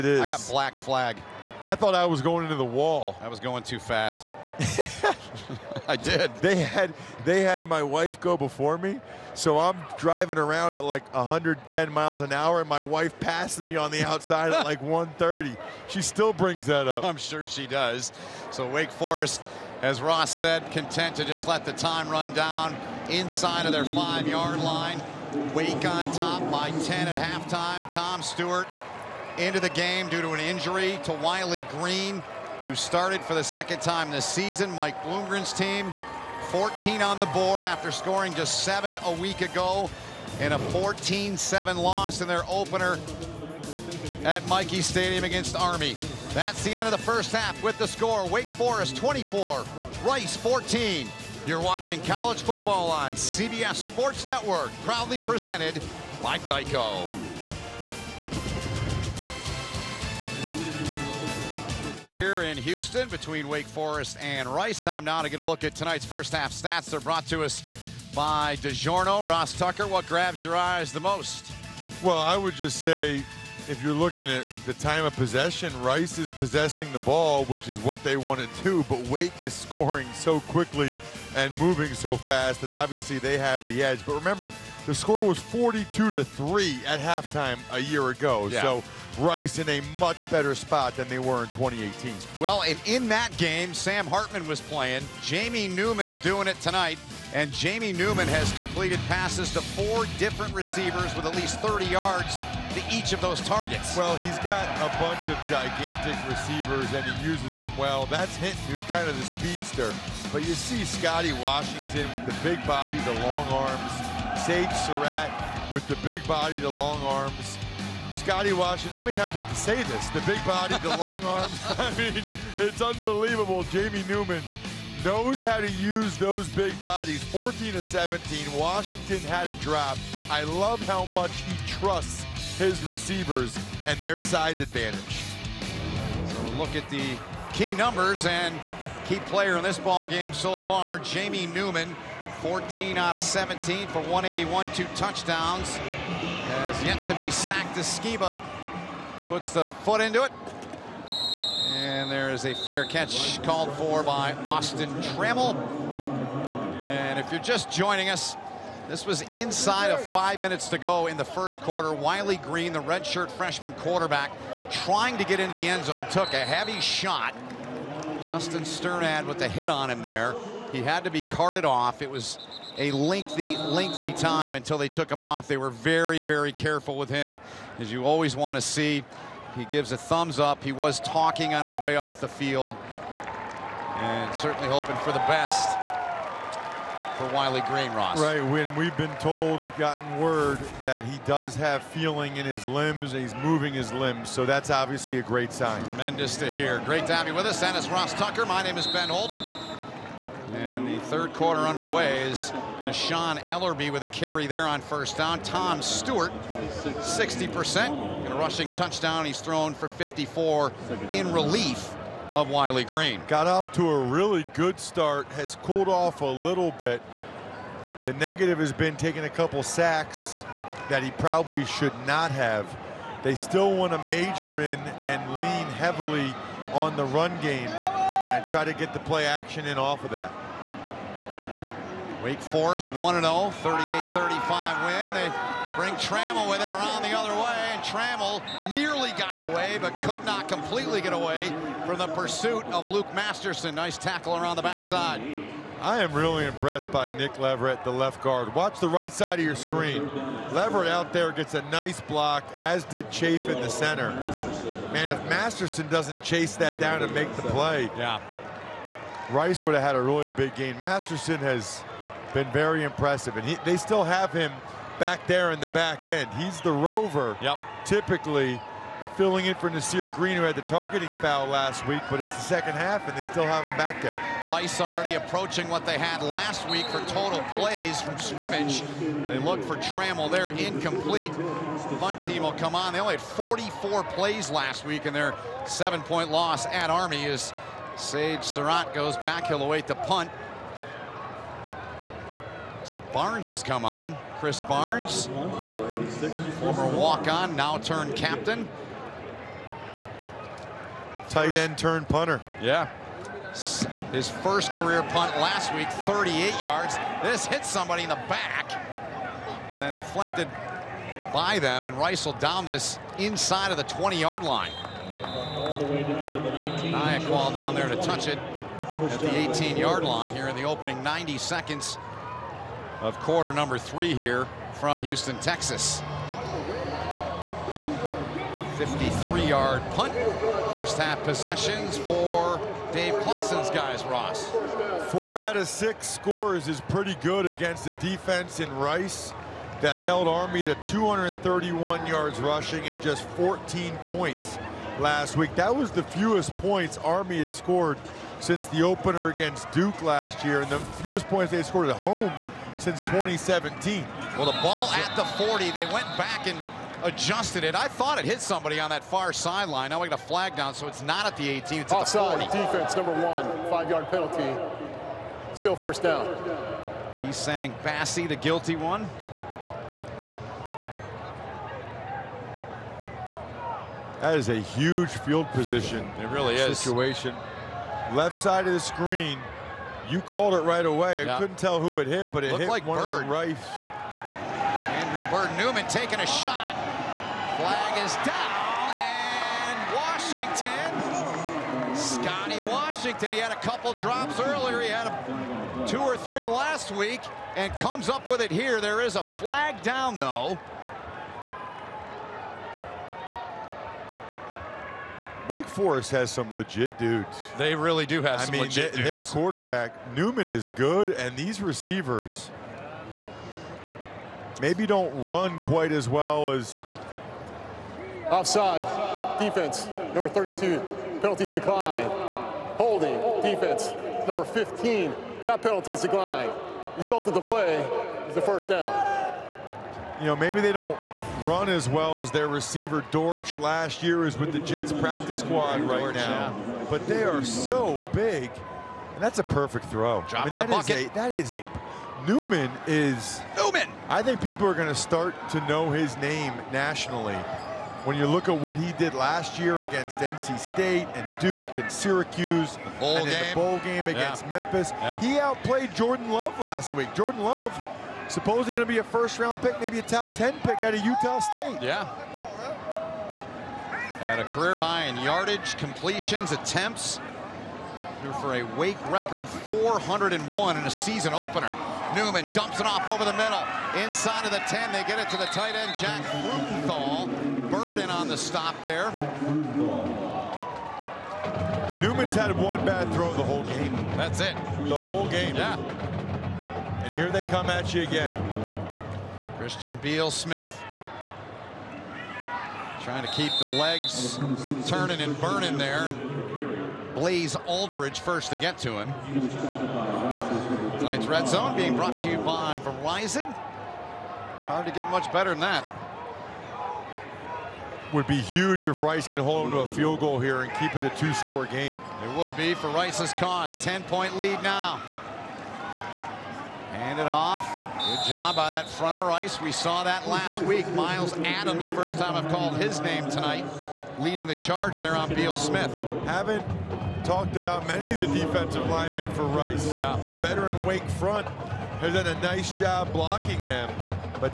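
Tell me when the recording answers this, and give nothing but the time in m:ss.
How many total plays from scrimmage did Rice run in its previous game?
4:43.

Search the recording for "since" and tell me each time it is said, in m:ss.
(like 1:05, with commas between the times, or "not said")
5:48, 5:52.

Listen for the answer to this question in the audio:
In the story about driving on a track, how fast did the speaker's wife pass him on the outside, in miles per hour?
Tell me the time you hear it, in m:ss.
0:14.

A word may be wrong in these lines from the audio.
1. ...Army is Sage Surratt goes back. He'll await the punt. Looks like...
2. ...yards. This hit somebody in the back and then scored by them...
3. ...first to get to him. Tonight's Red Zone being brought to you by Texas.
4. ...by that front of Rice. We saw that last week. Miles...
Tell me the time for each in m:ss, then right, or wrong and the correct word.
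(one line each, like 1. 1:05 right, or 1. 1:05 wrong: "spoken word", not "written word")
1. 4:46 right
2. 5:06 wrong: "deflected", not "scored"
3. 8:18 wrong: "Verizon", not "Texas"
4. 8:38 right.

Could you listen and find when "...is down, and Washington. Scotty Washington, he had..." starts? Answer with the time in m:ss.
6:28.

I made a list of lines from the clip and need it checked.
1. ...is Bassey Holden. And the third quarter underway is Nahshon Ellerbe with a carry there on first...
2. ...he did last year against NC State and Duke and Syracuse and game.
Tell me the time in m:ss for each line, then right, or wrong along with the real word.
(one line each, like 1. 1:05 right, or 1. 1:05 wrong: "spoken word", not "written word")
1. 3:18 wrong: "Ben", not "Bassey"
2. 7:28 right.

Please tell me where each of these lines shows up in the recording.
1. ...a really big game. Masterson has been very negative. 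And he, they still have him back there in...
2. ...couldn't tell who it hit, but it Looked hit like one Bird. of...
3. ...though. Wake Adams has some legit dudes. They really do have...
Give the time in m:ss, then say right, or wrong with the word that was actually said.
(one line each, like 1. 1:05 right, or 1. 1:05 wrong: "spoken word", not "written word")
1. 4:19 wrong: "impressive", not "negative"
2. 6:21 right
3. 6:40 wrong: "Forest", not "Adams".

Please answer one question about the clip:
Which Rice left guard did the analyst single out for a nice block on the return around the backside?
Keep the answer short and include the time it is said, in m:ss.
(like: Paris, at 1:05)
Nick Leverett, at 4:07.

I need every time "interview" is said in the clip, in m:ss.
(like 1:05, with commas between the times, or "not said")
not said.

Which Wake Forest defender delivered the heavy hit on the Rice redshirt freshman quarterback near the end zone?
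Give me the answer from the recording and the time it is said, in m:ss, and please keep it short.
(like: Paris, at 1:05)
Justin Strnad, at 2:48.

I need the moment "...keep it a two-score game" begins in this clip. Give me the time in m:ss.
8:30.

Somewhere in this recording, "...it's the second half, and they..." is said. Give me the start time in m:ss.
4:32.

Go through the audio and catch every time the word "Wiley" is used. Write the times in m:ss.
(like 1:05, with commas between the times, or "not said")
0:31, 2:41, 3:07, 3:32.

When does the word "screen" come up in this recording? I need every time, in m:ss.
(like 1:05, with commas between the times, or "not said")
4:09, 6:18.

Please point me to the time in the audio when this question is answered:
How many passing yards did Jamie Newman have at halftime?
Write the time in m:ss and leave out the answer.
2:24.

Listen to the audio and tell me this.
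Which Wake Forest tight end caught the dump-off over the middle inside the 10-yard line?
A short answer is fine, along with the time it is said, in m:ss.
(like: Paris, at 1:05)
Jack Freudenthal, at 7:55.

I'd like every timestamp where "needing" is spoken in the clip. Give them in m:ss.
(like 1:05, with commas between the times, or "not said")
not said.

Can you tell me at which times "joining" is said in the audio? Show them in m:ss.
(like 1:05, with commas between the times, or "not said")
2:37.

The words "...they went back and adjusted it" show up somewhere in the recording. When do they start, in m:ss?
5:55.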